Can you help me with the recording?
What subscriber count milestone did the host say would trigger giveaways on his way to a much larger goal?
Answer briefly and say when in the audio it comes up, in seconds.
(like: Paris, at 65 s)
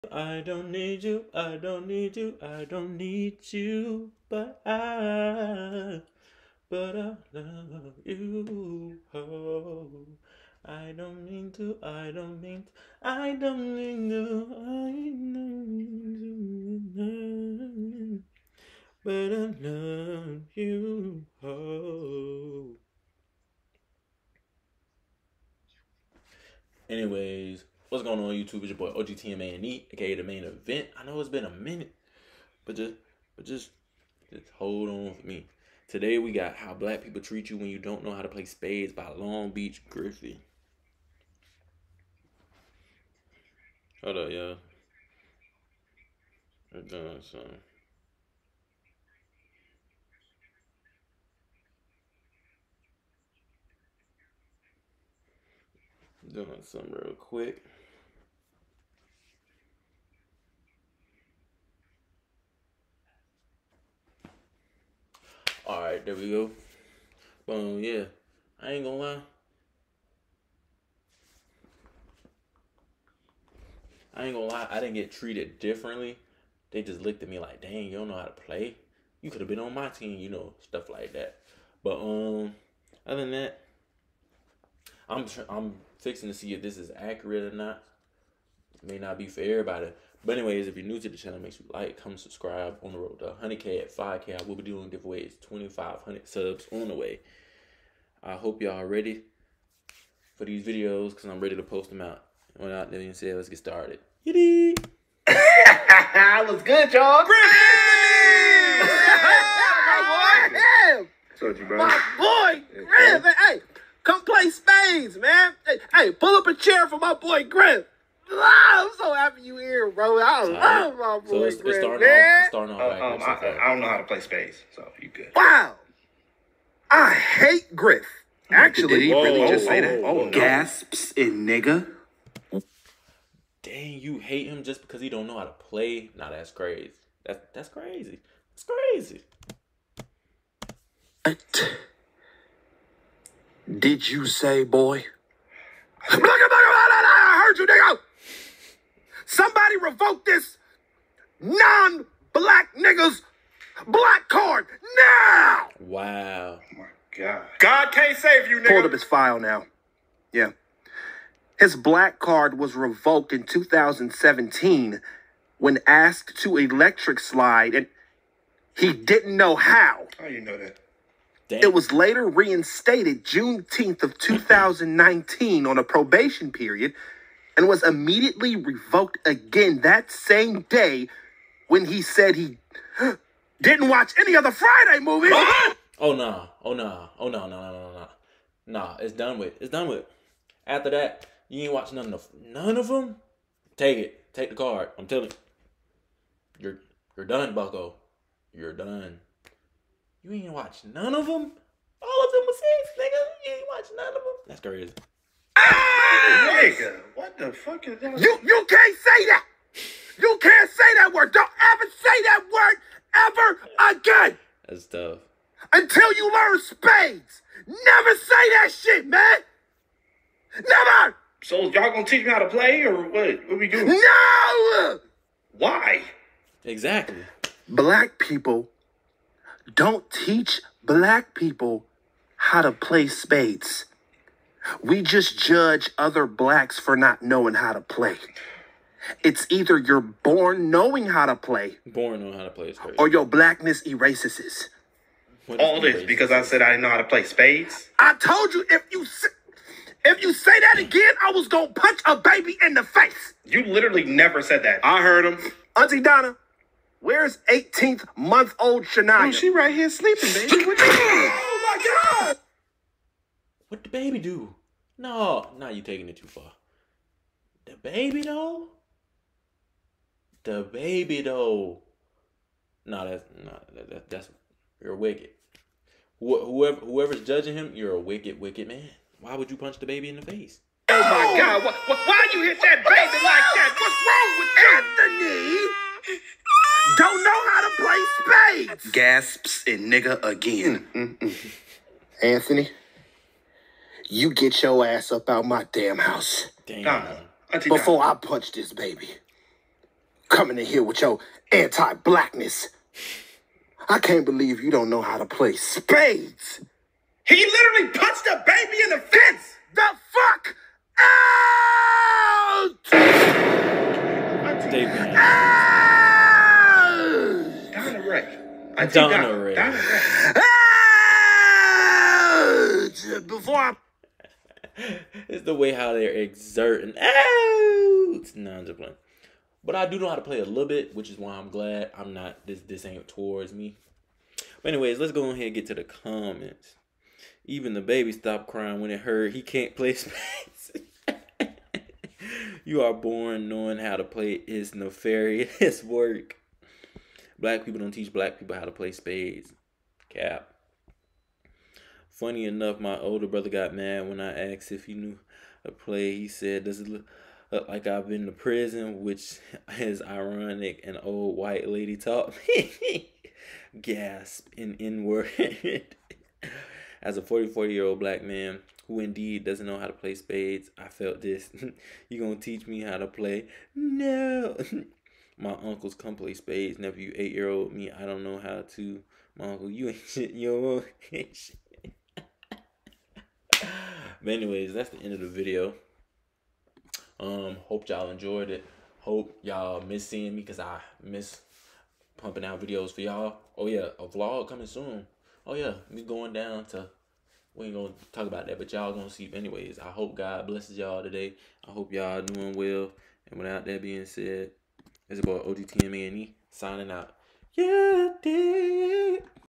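5K, at 93 s.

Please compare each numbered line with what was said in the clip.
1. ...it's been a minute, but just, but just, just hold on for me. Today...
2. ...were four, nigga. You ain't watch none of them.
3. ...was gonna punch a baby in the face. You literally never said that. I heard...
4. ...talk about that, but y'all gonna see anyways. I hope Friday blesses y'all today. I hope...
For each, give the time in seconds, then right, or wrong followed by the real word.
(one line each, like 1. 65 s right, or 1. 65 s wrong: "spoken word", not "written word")
1. 31 s right
2. 202 s wrong: "six", not "four"
3. 251 s right
4. 398 s wrong: "God", not "Friday".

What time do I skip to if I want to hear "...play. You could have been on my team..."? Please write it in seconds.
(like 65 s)
78 s.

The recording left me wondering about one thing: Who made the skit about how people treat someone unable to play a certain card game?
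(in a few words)
Long Beach Griffy.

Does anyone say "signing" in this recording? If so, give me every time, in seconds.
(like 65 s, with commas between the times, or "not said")
406 s.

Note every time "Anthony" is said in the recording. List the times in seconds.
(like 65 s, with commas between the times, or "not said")
285 s, 292 s.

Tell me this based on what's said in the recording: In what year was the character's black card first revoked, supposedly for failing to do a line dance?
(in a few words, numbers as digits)
2017.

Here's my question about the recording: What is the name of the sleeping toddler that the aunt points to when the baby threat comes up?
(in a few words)
Shania.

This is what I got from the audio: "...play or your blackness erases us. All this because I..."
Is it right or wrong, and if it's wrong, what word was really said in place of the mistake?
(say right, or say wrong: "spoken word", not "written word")
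right.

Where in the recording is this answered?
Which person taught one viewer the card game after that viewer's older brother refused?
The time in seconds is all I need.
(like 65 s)
360 s.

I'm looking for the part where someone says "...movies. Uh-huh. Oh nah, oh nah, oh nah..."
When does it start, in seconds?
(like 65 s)
184 s.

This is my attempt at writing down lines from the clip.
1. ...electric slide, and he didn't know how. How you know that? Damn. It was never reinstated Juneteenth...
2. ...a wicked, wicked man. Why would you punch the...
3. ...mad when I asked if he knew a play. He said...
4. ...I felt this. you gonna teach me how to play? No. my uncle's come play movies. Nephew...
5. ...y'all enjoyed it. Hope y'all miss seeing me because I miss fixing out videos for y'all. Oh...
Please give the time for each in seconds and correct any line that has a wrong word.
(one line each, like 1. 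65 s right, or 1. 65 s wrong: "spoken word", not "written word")
1. 166 s wrong: "later", not "never"
2. 277 s right
3. 353 s right
4. 370 s wrong: "spades", not "movies"
5. 387 s wrong: "pumping", not "fixing".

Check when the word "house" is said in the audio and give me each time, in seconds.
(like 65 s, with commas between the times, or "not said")
295 s.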